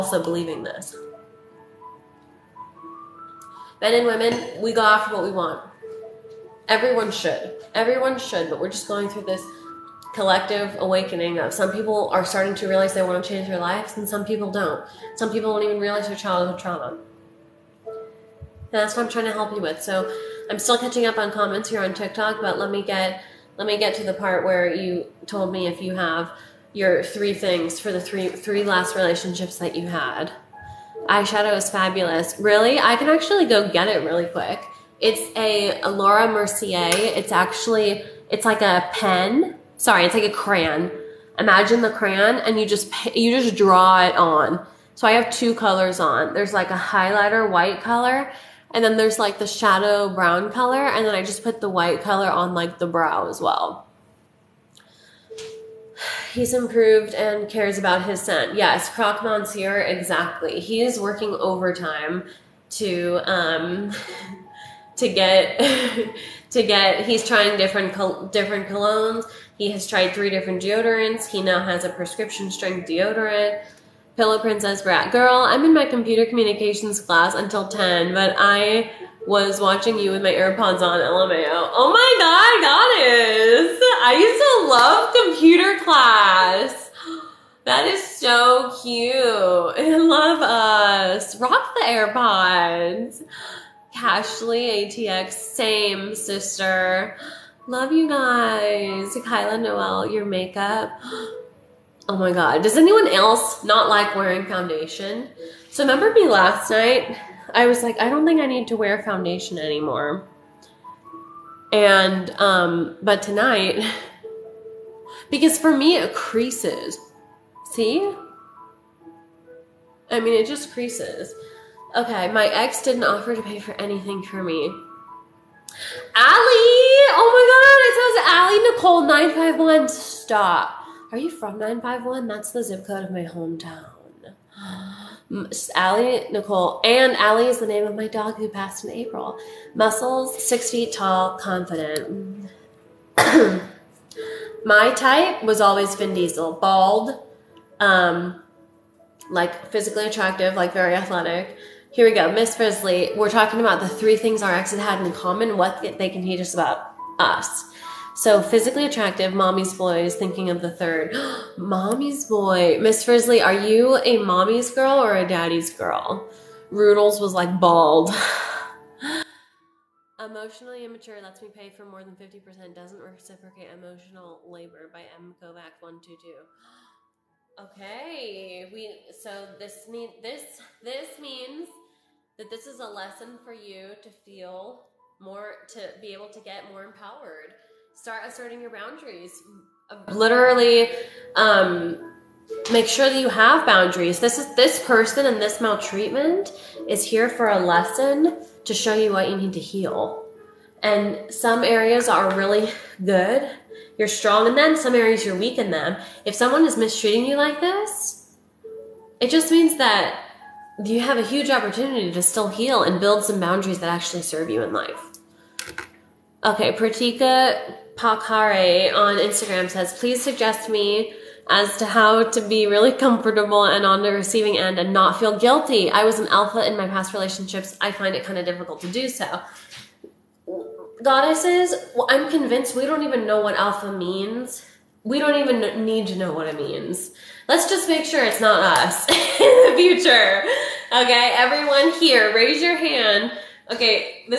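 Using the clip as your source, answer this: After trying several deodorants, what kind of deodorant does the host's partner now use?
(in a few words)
Prescription strength.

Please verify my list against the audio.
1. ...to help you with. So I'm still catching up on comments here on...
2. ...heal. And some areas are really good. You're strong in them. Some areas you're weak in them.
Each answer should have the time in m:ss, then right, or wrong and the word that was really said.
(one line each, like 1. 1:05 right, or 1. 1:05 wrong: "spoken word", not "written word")
1. 0:19 right
2. 3:19 right.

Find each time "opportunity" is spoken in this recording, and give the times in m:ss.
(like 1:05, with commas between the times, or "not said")
3:31.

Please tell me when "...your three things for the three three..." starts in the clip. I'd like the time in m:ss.
0:26.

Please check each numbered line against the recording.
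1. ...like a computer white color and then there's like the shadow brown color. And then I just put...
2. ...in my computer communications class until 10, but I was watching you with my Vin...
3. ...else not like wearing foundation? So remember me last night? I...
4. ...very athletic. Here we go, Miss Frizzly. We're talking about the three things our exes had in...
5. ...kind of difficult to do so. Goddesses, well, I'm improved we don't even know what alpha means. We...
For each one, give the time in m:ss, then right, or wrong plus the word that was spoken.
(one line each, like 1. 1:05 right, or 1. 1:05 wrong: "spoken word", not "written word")
1. 0:46 wrong: "highlighter", not "computer"
2. 1:15 wrong: "AirPods", not "Vin"
3. 1:43 right
4. 2:30 right
5. 3:48 wrong: "convinced", not "improved".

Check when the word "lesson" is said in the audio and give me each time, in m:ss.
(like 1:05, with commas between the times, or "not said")
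3:02, 3:17.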